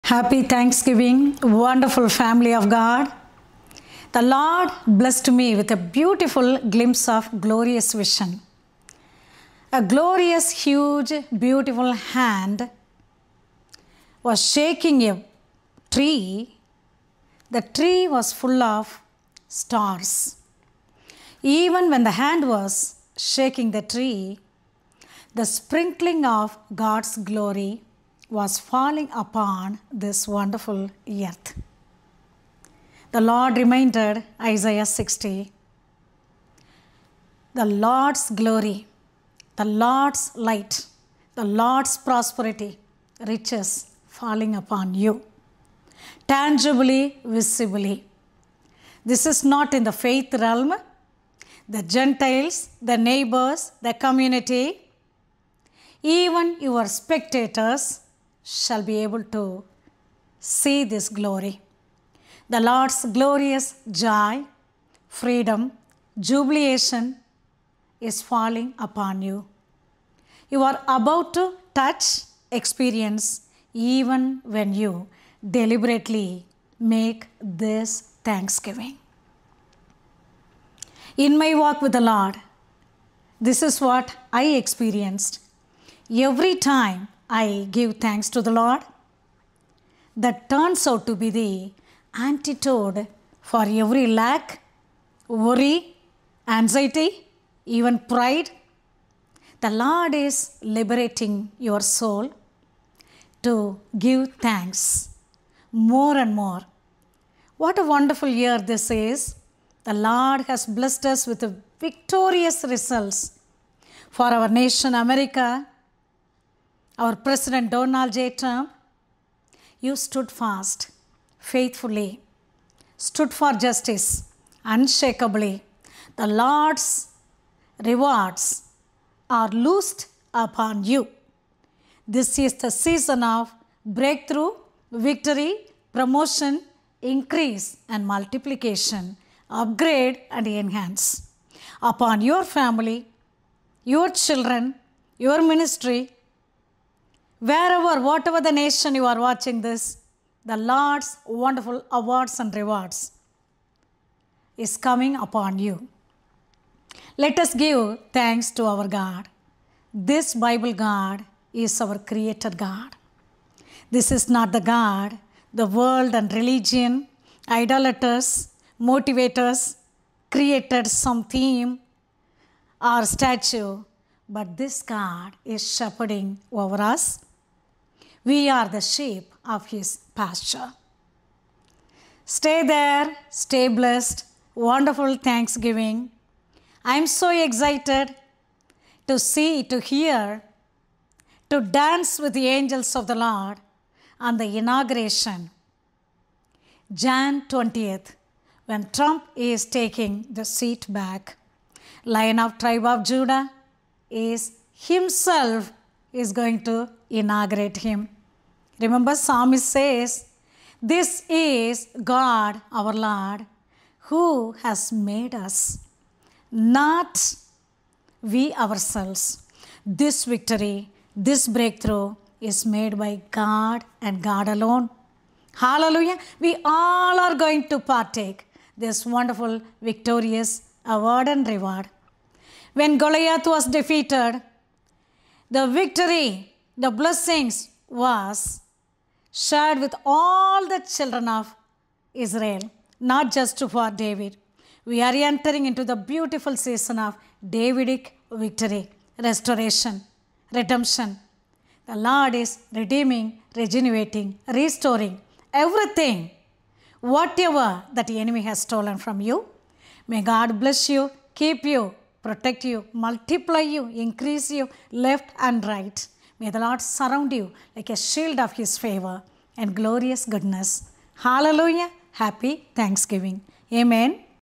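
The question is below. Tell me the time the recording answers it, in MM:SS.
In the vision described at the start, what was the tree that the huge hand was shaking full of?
00:19.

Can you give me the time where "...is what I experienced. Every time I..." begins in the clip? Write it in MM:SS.
01:23.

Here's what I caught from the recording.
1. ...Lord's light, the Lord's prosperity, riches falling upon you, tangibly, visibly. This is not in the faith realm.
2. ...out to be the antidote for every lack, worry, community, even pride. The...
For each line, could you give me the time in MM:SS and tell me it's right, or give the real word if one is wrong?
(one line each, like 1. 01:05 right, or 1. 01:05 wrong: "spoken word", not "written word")
1. 00:39 right
2. 01:30 wrong: "anxiety", not "community".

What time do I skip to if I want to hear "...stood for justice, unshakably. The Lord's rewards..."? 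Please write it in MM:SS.
02:02.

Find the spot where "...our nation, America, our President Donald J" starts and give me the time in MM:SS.
01:54.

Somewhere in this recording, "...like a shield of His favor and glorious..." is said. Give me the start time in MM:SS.
04:27.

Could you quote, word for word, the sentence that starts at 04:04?
We are entering into the beautiful season of Davidic victory, restoration, redemption.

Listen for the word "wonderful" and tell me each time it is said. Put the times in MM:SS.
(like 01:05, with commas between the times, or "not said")
00:01, 00:30, 01:47, 02:31, 03:04, 03:49.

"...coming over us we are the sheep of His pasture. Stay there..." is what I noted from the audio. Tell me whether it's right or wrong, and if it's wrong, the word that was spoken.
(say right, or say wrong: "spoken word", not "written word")
wrong: "shepherding", not "coming".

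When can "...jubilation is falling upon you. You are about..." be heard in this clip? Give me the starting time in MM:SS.
01:06.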